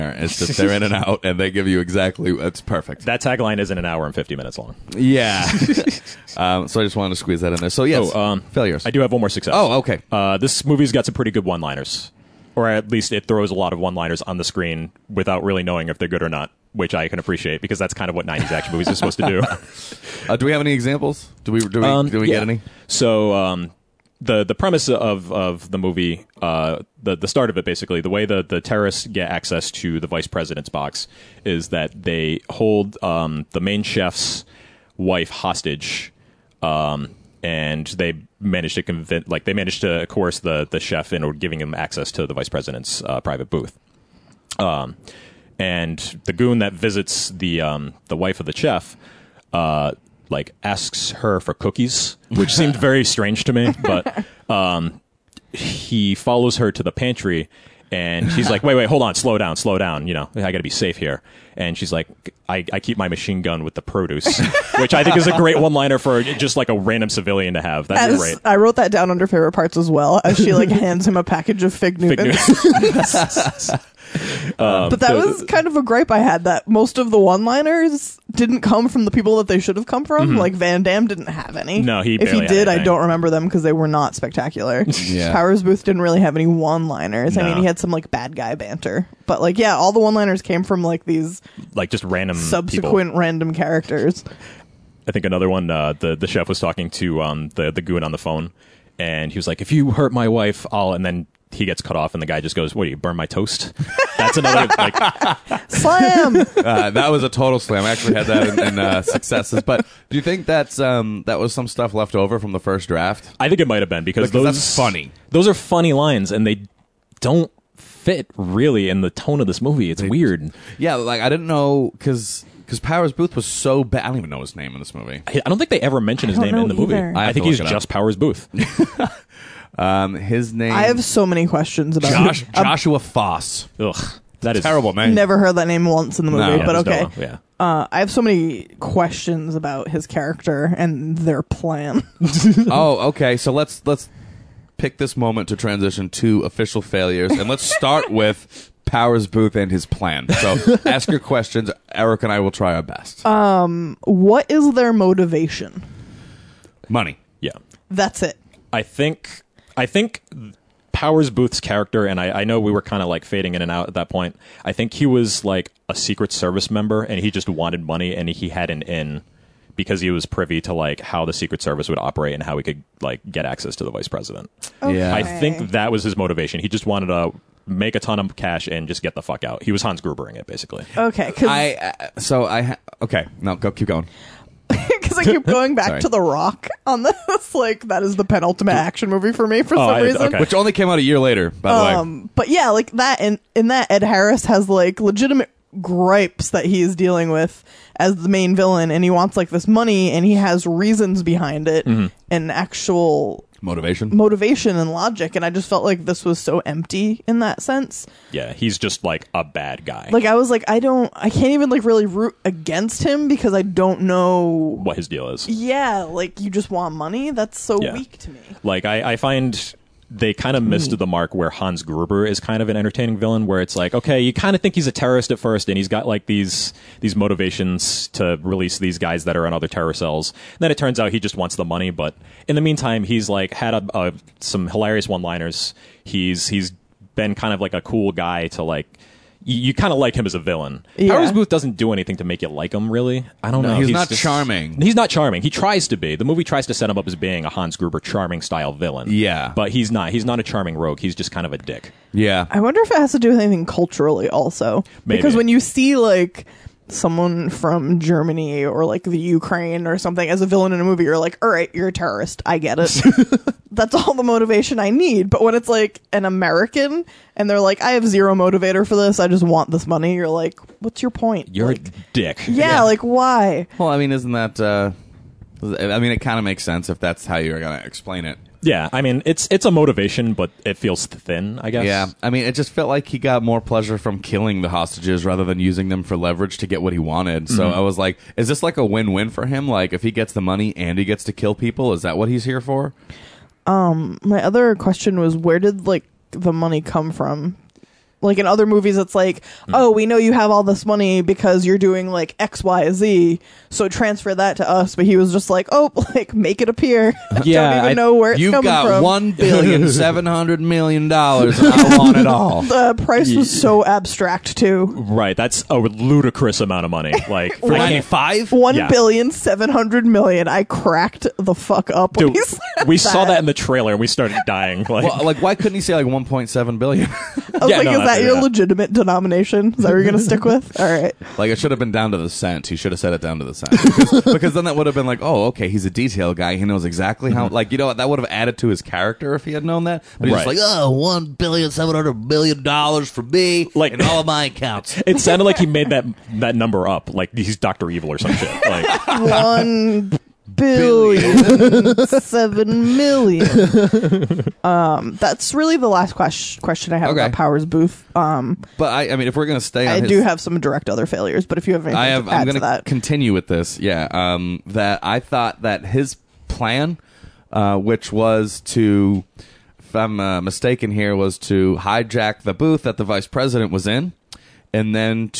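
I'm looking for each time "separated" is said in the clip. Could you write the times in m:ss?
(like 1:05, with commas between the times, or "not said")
not said.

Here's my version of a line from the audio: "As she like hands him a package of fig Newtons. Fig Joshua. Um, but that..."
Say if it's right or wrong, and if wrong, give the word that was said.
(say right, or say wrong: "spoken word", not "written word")
wrong: "Newtons", not "Joshua".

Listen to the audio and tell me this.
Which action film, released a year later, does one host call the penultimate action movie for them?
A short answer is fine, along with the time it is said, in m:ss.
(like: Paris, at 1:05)
The Rock, at 3:06.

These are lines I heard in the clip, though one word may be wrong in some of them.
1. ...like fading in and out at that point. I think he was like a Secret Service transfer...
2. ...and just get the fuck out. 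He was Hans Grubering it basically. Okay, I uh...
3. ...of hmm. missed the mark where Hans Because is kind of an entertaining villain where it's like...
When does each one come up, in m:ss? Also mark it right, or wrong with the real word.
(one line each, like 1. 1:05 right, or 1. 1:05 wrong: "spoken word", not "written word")
1. 2:43 wrong: "member", not "transfer"
2. 2:58 right
3. 3:40 wrong: "Gruber", not "Because".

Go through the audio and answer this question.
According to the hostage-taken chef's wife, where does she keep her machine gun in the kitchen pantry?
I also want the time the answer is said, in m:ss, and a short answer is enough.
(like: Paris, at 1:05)
with the produce, at 1:03.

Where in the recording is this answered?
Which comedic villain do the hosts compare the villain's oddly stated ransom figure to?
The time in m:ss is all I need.
5:47.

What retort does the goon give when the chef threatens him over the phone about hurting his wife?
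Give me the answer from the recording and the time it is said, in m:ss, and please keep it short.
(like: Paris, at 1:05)
What do you burn my toast?, at 1:42.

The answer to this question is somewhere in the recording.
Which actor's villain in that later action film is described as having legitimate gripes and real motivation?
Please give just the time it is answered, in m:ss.
3:13.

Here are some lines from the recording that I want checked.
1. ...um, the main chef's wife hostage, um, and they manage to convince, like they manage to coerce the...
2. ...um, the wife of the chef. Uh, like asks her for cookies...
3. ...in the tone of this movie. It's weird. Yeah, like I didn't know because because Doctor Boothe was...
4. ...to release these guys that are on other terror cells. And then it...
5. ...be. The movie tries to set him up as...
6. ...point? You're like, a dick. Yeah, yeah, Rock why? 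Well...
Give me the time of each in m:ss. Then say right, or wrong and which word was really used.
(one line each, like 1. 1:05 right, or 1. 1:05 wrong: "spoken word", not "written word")
1. 0:33 right
2. 0:47 right
3. 1:58 wrong: "Powers", not "Doctor"
4. 3:48 right
5. 4:05 right
6. 4:31 wrong: "Like", not "Rock".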